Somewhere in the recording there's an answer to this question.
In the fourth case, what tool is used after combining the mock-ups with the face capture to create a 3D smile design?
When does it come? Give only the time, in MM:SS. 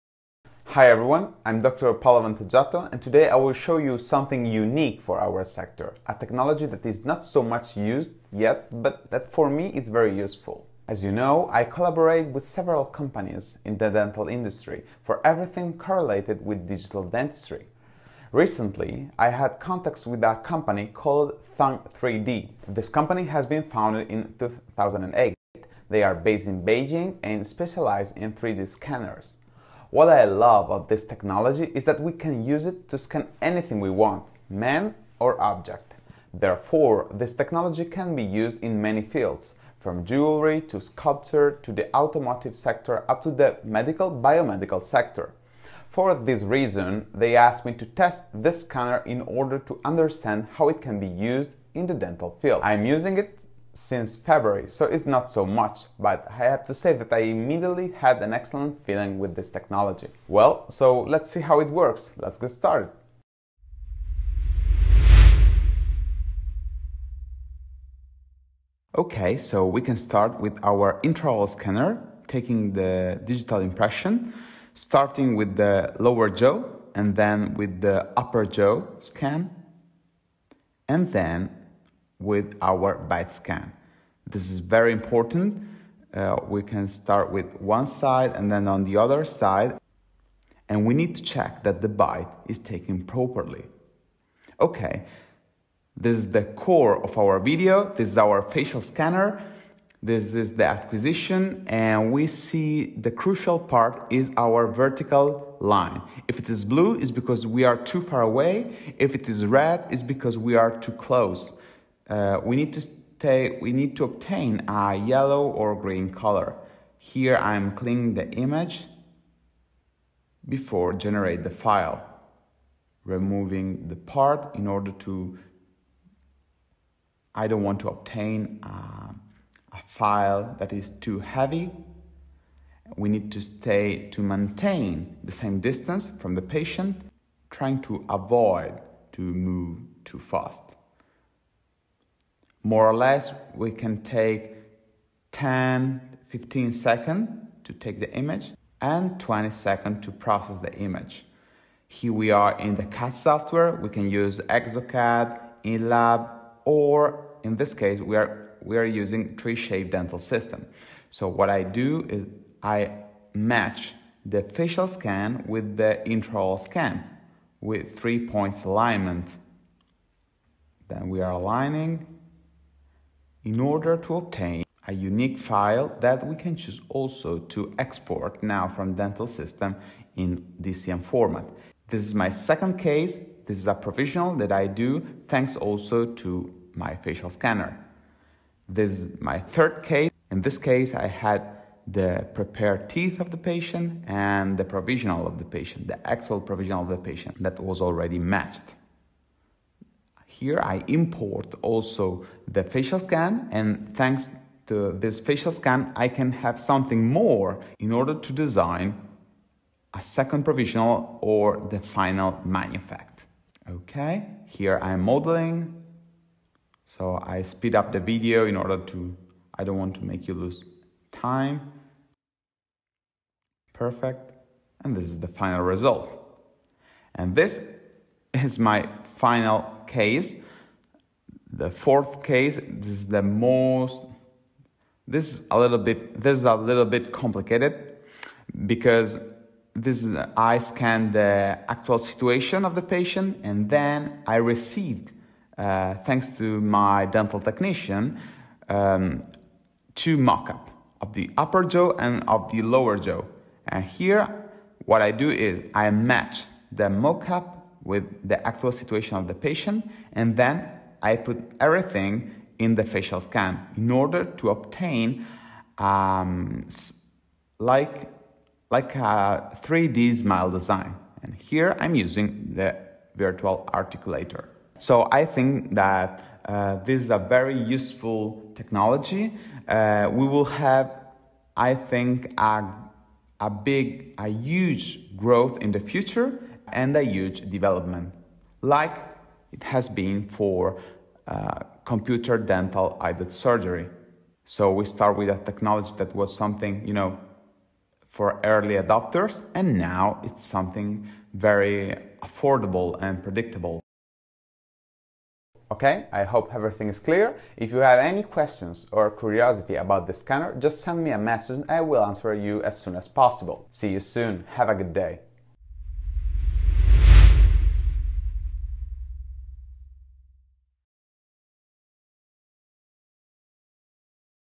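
04:33.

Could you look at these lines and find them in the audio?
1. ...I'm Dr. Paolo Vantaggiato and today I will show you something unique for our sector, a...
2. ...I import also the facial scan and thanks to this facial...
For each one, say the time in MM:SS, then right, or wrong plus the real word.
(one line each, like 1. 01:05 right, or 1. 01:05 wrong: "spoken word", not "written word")
1. 00:01 right
2. 03:20 right.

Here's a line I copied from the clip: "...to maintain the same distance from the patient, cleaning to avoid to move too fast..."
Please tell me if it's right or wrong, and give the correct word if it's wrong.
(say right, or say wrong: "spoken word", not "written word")
wrong: "trying", not "cleaning".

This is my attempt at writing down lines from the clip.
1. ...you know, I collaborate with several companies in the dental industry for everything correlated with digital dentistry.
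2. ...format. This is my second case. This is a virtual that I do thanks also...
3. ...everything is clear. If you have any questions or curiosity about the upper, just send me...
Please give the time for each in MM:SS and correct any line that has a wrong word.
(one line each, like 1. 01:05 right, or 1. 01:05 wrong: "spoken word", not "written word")
1. 00:11 right
2. 03:01 wrong: "provisional", not "virtual"
3. 05:06 wrong: "scanner", not "upper".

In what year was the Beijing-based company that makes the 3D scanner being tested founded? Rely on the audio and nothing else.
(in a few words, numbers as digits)
2008.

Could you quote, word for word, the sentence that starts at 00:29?
What I love of this technology is that we can use it to scan anything we want, man or object.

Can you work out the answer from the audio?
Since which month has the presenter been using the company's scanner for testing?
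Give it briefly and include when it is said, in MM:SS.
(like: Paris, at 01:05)
February, at 00:54.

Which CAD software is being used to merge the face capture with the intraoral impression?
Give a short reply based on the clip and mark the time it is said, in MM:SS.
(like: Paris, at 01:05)
3Shape Dental System, at 02:39.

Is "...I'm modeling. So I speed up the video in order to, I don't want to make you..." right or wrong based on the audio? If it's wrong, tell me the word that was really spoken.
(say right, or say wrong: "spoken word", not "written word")
right.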